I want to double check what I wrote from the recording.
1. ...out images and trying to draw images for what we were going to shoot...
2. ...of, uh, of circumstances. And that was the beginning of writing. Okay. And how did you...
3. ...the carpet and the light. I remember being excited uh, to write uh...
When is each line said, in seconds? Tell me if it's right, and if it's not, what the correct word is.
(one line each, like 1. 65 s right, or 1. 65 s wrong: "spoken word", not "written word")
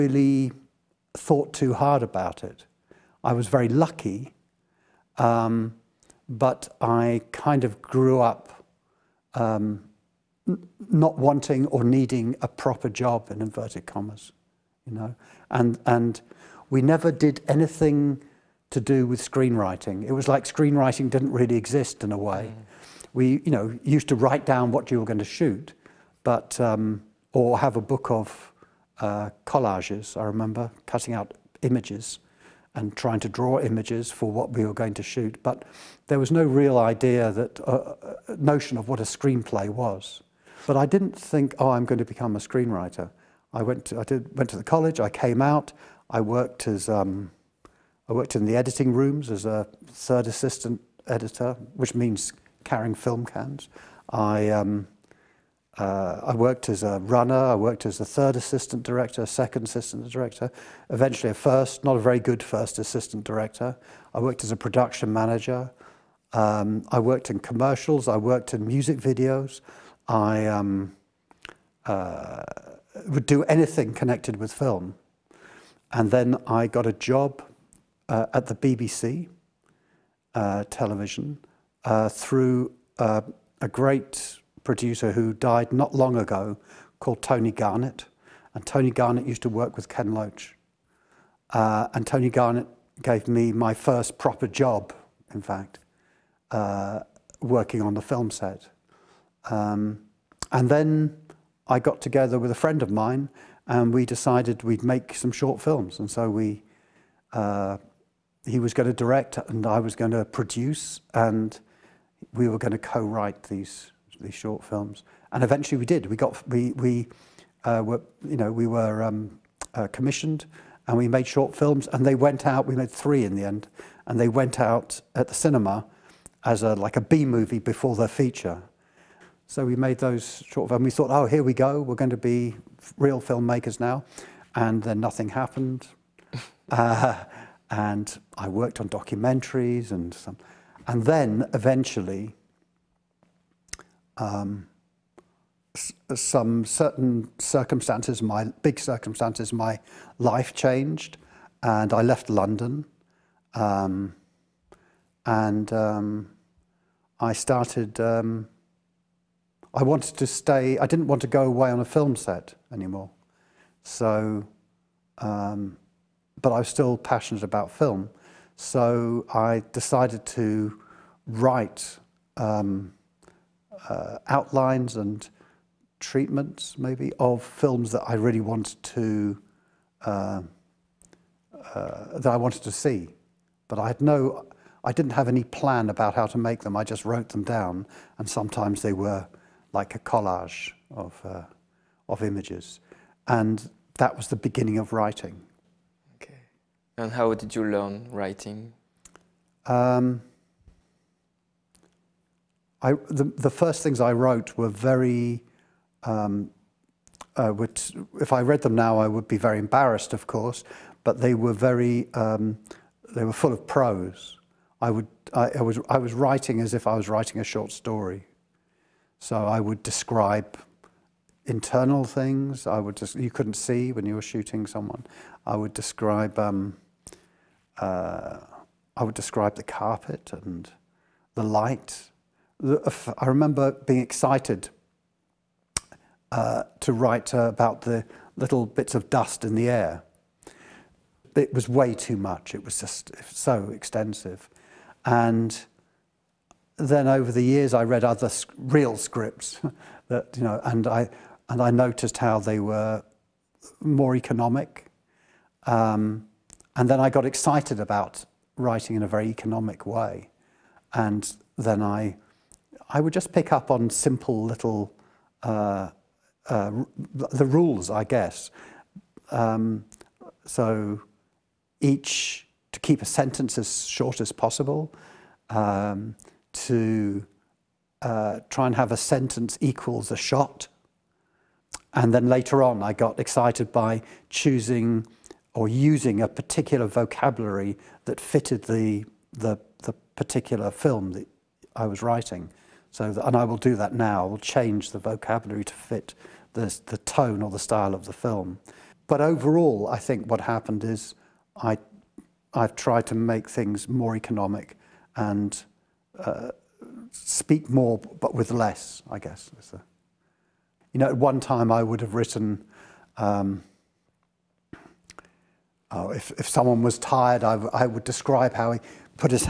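1. 31 s right
2. 191 s wrong: "images", not "circumstances"
3. 229 s right.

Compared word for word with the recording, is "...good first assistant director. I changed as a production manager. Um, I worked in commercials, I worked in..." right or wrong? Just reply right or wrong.
wrong.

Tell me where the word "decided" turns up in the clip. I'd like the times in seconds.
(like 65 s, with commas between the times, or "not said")
104 s, 169 s.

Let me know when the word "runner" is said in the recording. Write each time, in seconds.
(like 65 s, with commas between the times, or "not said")
56 s.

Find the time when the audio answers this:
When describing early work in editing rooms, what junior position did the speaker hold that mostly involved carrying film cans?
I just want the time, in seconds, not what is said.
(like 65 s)
49 s.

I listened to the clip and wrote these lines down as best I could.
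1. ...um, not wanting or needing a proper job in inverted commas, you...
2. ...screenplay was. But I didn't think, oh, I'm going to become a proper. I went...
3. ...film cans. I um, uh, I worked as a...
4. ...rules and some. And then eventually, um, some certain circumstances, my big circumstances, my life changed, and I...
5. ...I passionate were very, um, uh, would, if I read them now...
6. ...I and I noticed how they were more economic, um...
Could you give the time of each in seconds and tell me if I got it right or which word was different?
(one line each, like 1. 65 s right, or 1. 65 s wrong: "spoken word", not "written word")
1. 9 s right
2. 39 s wrong: "screenwriter", not "proper"
3. 52 s right
4. 138 s wrong: "documentaries", not "rules"
5. 203 s wrong: "wrote", not "passionate"
6. 250 s right.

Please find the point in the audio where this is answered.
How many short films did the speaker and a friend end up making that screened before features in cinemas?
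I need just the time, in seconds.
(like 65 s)
122 s.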